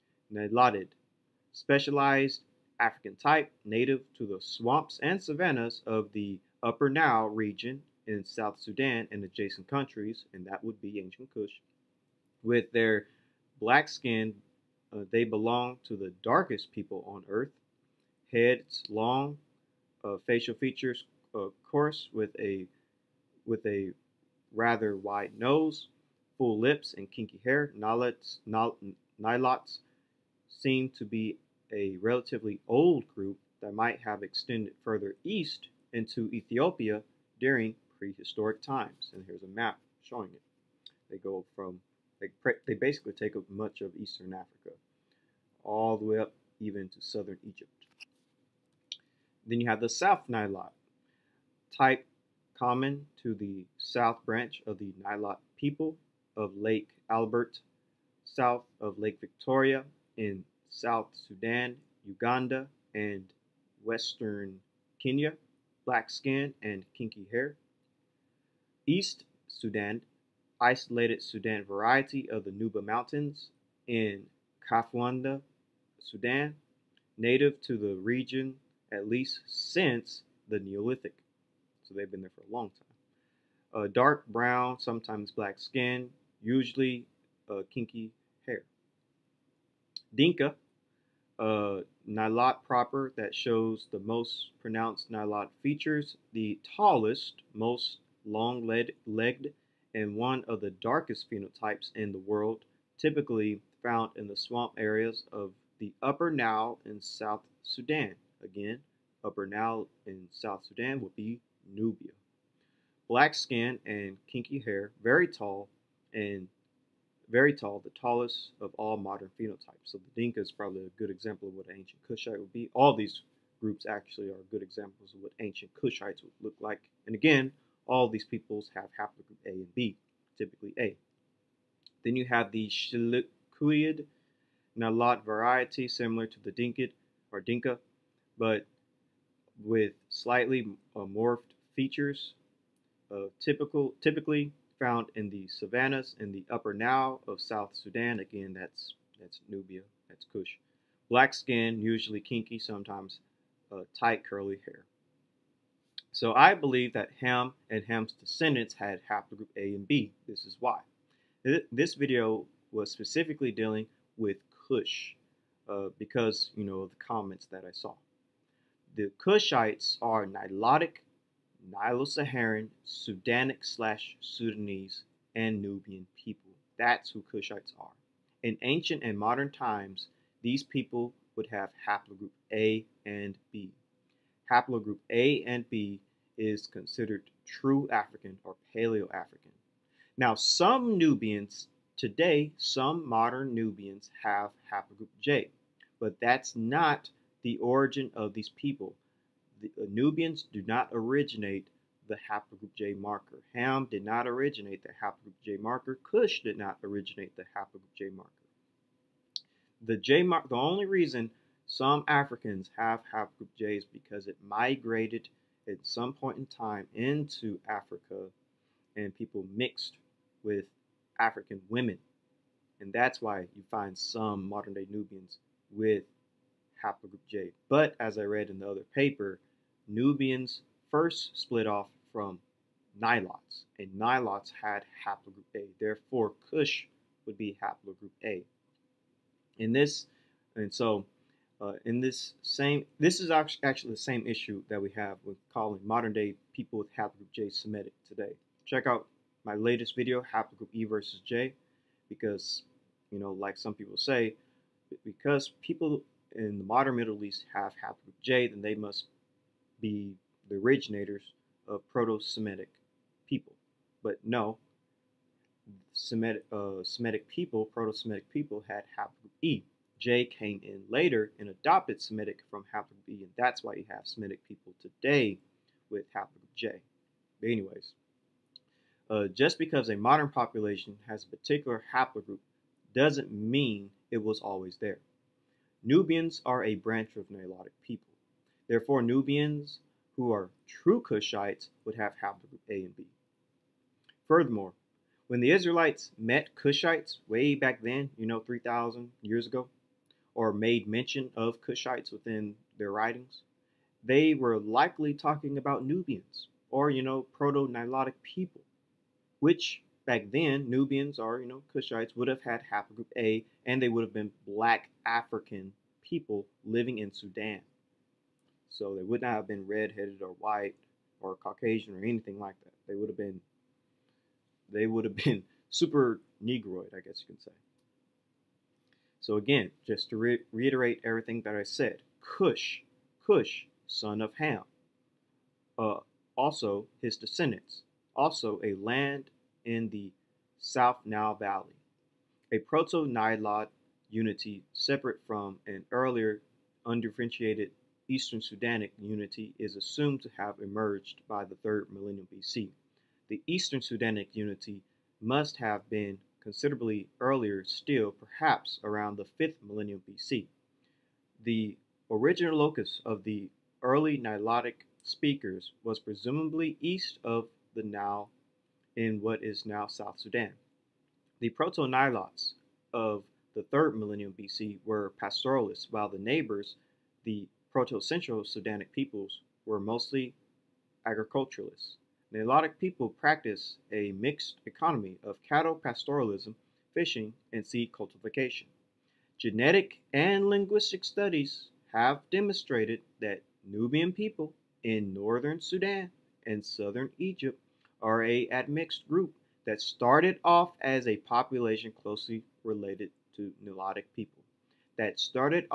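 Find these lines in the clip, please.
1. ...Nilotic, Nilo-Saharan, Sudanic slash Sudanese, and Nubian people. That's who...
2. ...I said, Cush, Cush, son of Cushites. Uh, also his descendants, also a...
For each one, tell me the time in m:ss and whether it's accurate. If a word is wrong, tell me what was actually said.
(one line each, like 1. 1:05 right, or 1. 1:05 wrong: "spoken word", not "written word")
1. 2:50 right
2. 5:31 wrong: "Ham", not "Cushites".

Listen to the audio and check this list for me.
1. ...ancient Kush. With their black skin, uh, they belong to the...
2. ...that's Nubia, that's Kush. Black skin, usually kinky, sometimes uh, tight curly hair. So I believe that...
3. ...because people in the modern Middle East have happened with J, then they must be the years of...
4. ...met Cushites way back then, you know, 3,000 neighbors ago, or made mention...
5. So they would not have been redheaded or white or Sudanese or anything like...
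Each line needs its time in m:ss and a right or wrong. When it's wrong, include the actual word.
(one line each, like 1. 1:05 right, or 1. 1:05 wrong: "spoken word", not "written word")
1. 0:10 right
2. 2:29 right
3. 4:15 wrong: "originators", not "years"
4. 4:56 wrong: "years", not "neighbors"
5. 5:18 wrong: "Caucasian", not "Sudanese".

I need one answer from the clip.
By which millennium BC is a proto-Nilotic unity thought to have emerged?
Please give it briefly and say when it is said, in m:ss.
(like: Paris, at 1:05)
3rd millennium BC, at 5:51.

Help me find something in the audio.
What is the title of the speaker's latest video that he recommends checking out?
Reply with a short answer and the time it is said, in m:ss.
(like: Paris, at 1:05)
Haplogroup E versus J, at 4:10.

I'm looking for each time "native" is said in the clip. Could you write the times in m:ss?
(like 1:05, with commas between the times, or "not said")
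0:03, 1:17.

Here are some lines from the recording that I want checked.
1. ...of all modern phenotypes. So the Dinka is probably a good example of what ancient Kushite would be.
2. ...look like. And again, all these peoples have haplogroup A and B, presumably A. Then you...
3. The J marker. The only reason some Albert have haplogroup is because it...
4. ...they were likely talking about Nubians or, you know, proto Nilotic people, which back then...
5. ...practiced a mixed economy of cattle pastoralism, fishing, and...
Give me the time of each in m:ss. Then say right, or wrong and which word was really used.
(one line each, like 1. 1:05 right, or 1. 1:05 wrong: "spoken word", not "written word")
1. 1:58 right
2. 2:06 wrong: "typically", not "presumably"
3. 3:29 wrong: "Africans", not "Albert"
4. 5:04 right
5. 6:23 right.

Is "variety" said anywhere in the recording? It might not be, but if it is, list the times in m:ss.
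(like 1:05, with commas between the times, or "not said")
1:11, 2:15.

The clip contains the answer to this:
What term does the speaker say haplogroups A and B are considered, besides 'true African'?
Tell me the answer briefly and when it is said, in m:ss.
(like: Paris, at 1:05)
Paleo-African, at 3:08.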